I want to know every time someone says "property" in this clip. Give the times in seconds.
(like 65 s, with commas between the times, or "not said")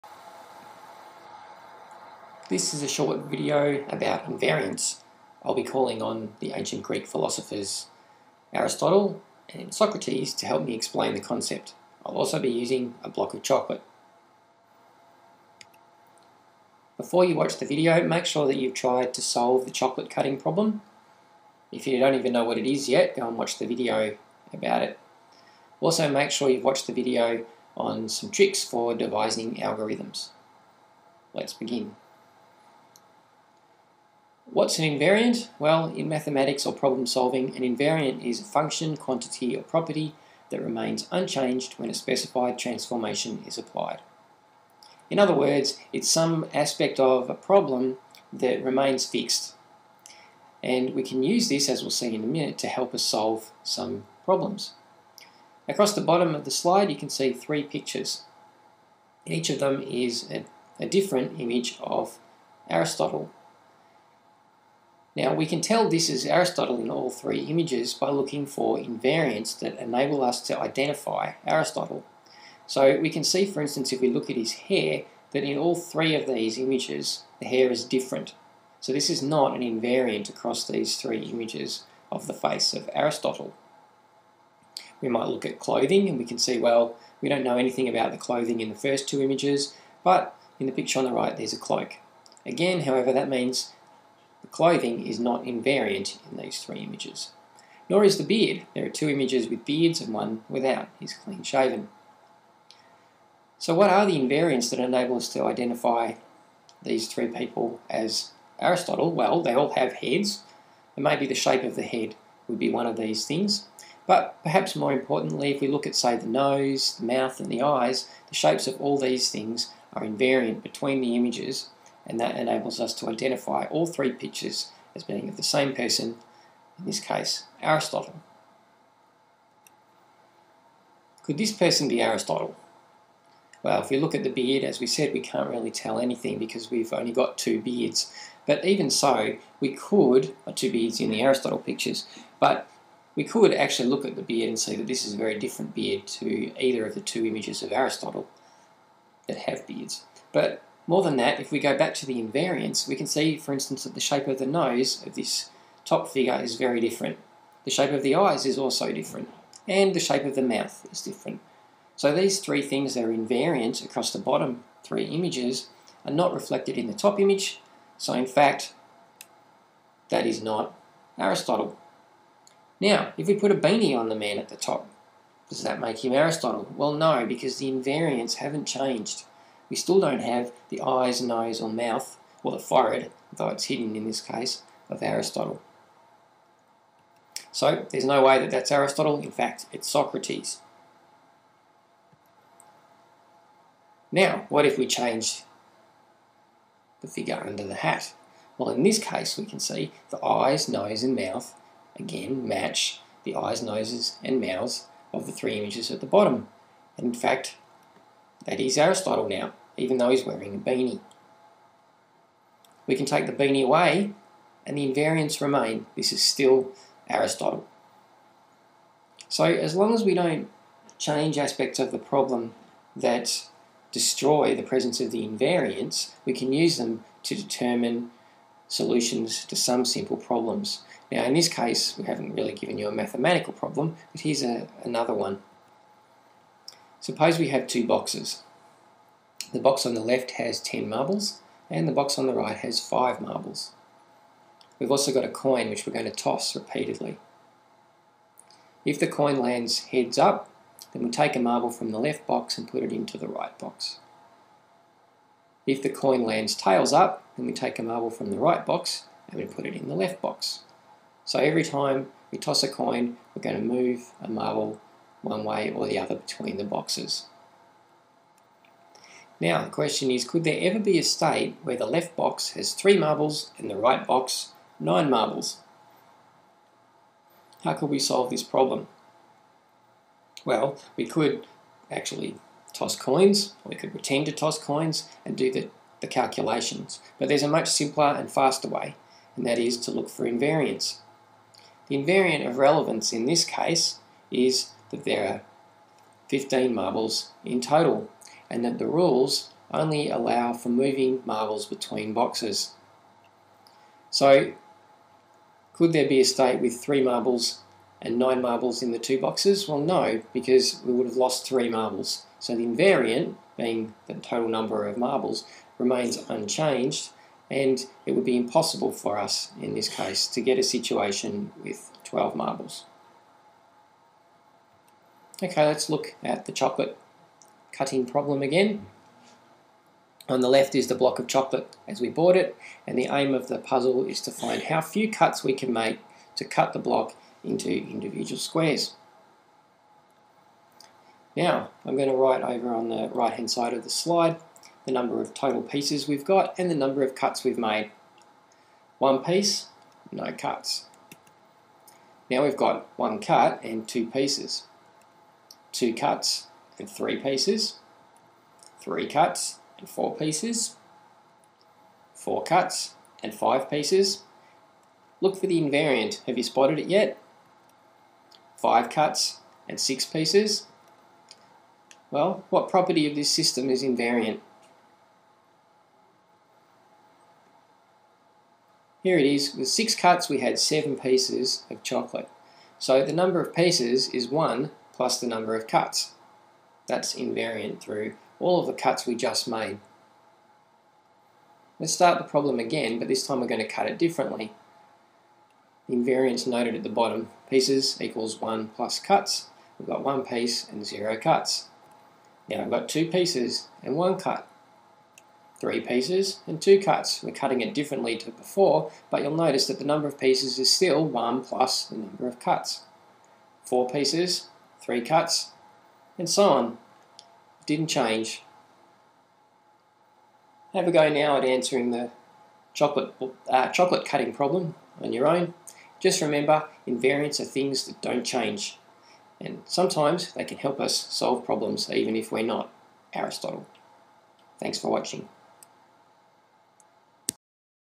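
39 s, 372 s.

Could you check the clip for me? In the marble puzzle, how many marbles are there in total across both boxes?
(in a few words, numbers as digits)
15.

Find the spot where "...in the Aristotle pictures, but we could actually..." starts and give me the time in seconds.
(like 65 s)
140 s.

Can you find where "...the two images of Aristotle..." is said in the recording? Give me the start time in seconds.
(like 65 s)
146 s.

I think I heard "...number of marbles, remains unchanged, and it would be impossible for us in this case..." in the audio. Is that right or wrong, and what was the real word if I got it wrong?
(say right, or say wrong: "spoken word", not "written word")
right.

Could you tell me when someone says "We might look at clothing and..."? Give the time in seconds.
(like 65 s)
85 s.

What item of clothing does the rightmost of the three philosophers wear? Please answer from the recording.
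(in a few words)
A cloak.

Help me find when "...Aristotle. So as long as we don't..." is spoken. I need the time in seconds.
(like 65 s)
217 s.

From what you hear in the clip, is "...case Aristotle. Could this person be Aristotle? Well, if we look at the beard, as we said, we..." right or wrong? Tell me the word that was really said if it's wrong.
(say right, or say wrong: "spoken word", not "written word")
right.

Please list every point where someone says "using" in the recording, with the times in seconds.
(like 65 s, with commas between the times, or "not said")
12 s.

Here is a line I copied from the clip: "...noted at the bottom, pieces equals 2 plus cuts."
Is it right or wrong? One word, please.
wrong.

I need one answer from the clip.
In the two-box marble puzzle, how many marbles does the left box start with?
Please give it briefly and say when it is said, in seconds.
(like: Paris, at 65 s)
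10, at 240 s.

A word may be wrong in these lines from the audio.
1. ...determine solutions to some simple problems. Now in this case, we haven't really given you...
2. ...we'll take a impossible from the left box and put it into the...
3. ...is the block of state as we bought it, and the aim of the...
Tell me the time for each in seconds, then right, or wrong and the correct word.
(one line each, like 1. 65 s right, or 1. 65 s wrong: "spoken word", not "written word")
1. 227 s right
2. 251 s wrong: "marble", not "impossible"
3. 330 s wrong: "chocolate", not "state".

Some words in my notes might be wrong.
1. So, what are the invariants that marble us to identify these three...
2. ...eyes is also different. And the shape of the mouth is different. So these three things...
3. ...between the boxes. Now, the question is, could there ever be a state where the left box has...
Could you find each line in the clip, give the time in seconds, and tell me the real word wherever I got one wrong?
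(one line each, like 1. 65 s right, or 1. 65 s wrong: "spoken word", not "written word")
1. 103 s wrong: "enable", not "marble"
2. 158 s right
3. 266 s right.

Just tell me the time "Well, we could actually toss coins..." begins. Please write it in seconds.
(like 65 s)
280 s.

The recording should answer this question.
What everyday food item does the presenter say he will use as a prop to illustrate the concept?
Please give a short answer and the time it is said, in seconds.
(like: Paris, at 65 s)
A block of chocolate, at 13 s.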